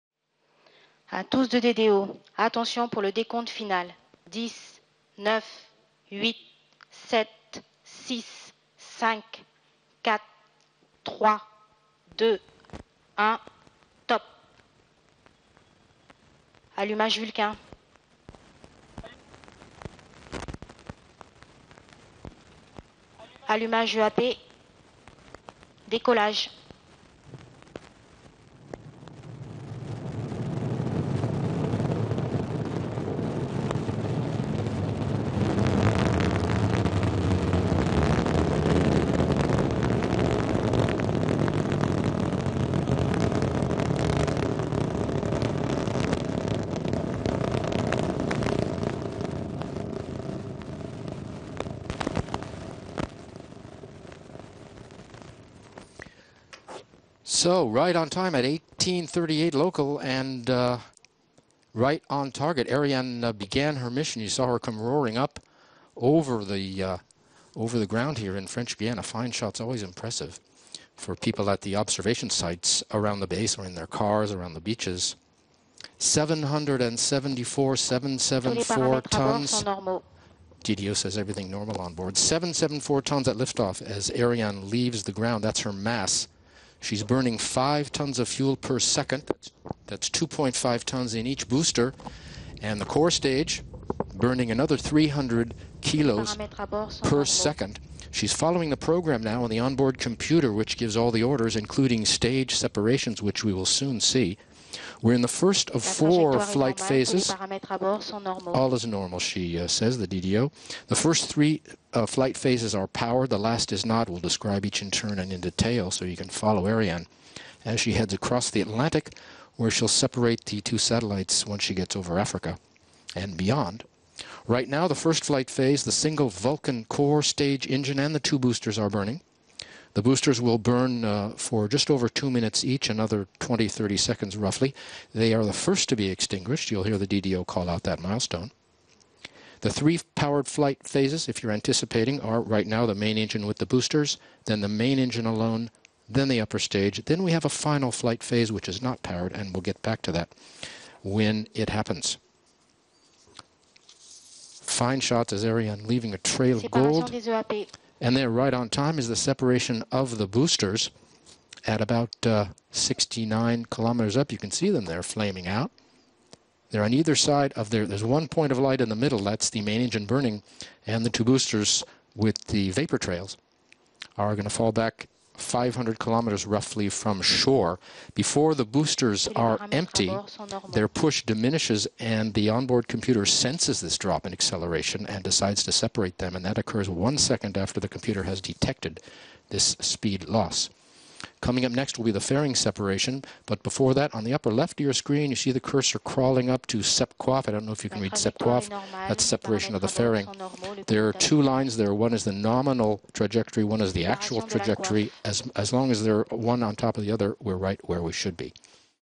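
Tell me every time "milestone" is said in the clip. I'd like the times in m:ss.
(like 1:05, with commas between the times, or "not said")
2:18.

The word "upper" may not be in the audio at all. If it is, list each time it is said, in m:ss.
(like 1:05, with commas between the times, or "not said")
2:26, 3:14.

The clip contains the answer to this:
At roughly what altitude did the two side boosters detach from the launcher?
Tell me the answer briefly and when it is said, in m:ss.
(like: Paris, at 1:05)
69 kilometers, at 2:42.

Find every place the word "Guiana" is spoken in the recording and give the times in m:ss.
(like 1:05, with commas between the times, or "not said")
1:08.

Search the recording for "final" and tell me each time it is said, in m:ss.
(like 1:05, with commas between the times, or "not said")
0:03, 2:27.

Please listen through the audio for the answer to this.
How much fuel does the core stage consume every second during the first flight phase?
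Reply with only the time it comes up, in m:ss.
1:34.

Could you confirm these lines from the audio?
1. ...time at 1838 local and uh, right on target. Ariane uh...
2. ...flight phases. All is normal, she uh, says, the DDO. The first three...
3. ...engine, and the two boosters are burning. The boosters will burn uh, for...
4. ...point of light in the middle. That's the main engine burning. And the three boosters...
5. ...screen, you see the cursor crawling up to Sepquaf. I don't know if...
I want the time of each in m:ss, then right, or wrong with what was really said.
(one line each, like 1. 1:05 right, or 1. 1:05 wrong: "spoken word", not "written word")
1. 0:58 right
2. 1:46 right
3. 2:07 right
4. 2:48 wrong: "two", not "three"
5. 3:14 right.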